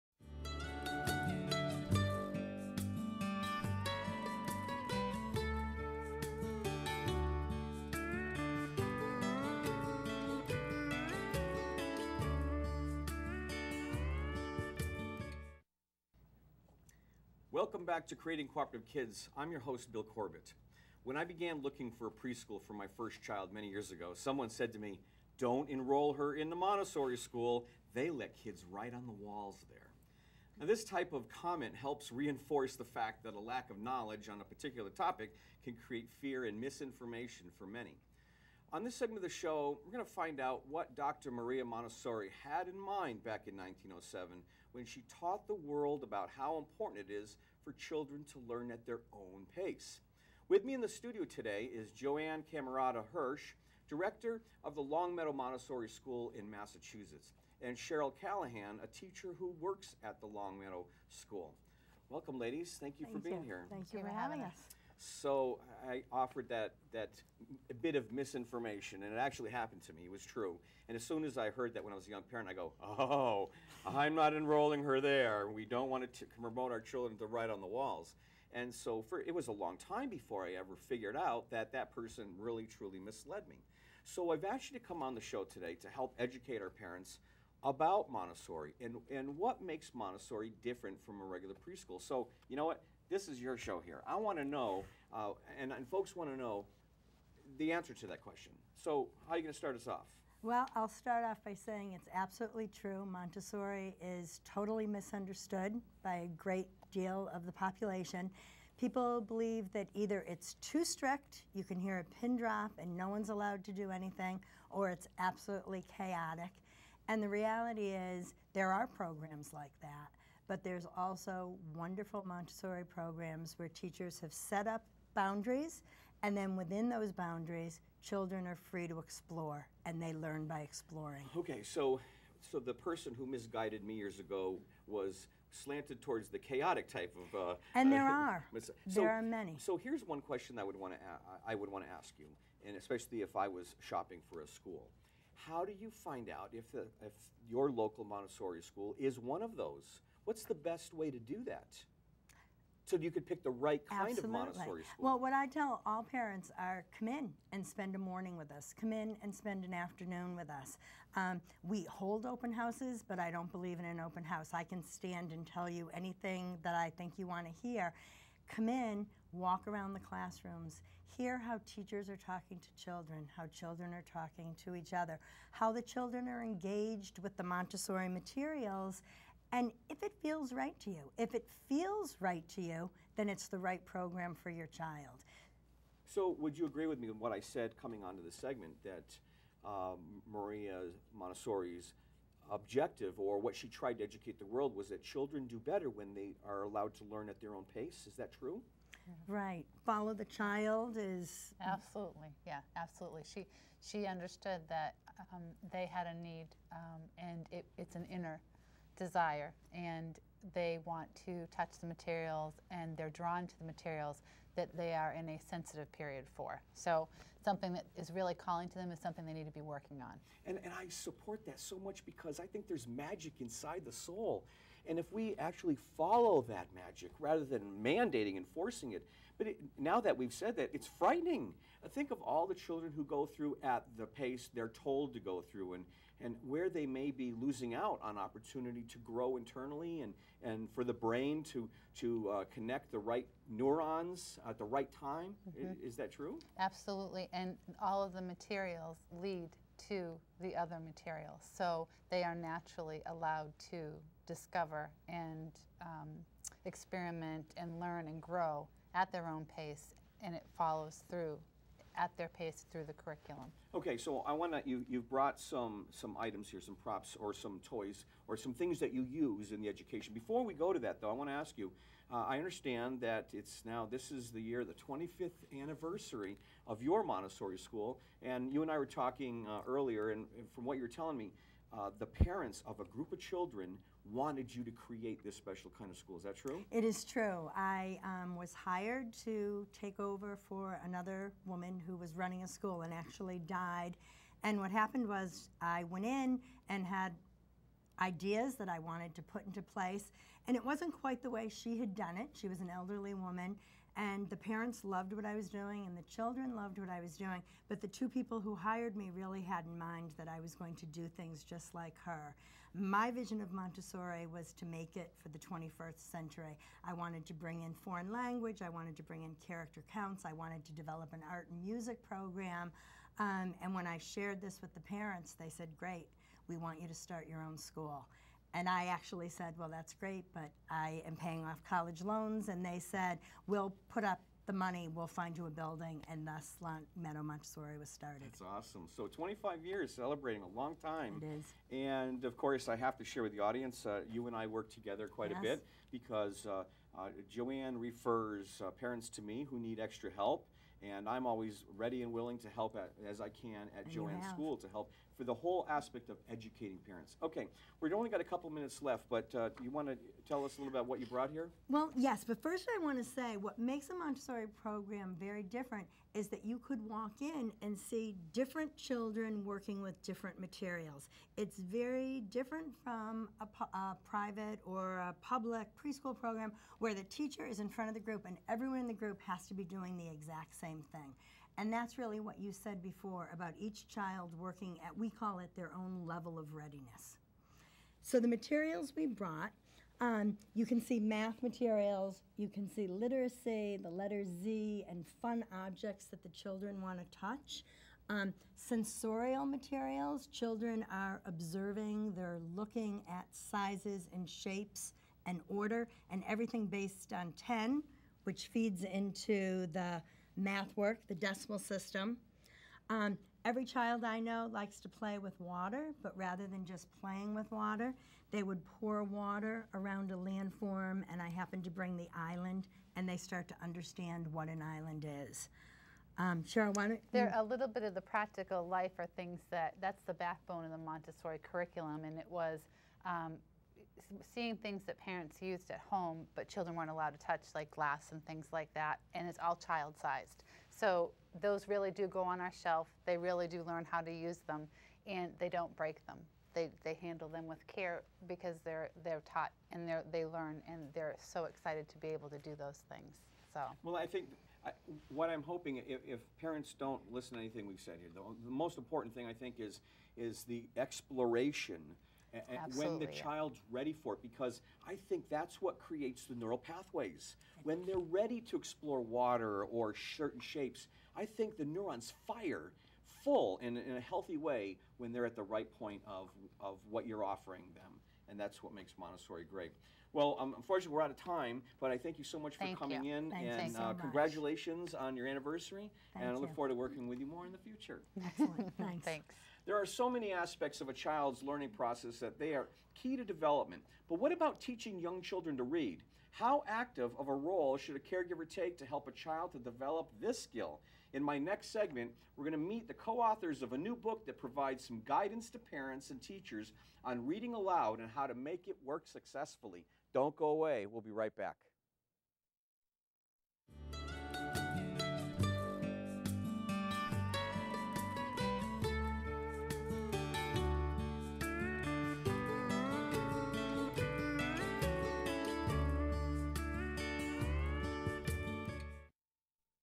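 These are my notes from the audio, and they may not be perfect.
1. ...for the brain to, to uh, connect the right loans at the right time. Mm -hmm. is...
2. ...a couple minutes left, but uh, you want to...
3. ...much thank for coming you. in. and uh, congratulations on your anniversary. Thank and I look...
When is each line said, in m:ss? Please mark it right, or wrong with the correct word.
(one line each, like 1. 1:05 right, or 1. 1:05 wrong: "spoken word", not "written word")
1. 4:00 wrong: "neurons", not "loans"
2. 5:58 right
3. 8:02 right.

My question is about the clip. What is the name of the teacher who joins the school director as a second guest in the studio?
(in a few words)
Cheryl Callahan.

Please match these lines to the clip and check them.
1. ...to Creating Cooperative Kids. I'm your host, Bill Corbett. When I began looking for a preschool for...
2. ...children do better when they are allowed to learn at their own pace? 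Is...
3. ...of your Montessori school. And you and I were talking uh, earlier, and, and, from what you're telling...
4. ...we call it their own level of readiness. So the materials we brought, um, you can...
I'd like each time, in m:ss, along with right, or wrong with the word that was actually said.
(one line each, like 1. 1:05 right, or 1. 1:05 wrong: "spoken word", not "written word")
1. 0:18 right
2. 3:15 right
3. 4:36 right
4. 6:24 right.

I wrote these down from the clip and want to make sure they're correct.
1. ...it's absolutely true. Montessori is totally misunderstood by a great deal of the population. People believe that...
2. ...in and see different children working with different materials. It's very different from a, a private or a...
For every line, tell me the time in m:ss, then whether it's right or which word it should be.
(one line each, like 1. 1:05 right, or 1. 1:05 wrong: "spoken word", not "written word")
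1. 1:41 right
2. 6:07 right.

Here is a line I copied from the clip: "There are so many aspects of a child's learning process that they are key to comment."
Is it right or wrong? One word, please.
wrong.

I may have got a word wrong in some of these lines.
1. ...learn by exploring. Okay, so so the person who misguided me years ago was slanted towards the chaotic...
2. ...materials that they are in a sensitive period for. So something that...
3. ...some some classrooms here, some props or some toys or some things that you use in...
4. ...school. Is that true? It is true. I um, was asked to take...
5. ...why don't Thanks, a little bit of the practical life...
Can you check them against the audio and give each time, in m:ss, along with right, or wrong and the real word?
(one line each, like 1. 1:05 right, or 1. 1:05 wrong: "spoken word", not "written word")
1. 2:10 right
2. 3:33 right
3. 4:25 wrong: "items", not "classrooms"
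4. 4:45 wrong: "hired", not "asked"
5. 7:06 wrong: "There", not "Thanks".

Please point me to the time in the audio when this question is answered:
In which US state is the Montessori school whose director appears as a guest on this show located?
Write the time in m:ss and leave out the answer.
0:56.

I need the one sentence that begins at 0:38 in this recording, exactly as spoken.
On this segment of the show, we're going to find out what Dr.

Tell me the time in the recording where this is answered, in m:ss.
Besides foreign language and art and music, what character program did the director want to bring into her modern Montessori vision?
5:19.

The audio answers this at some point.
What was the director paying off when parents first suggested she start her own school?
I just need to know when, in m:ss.
5:31.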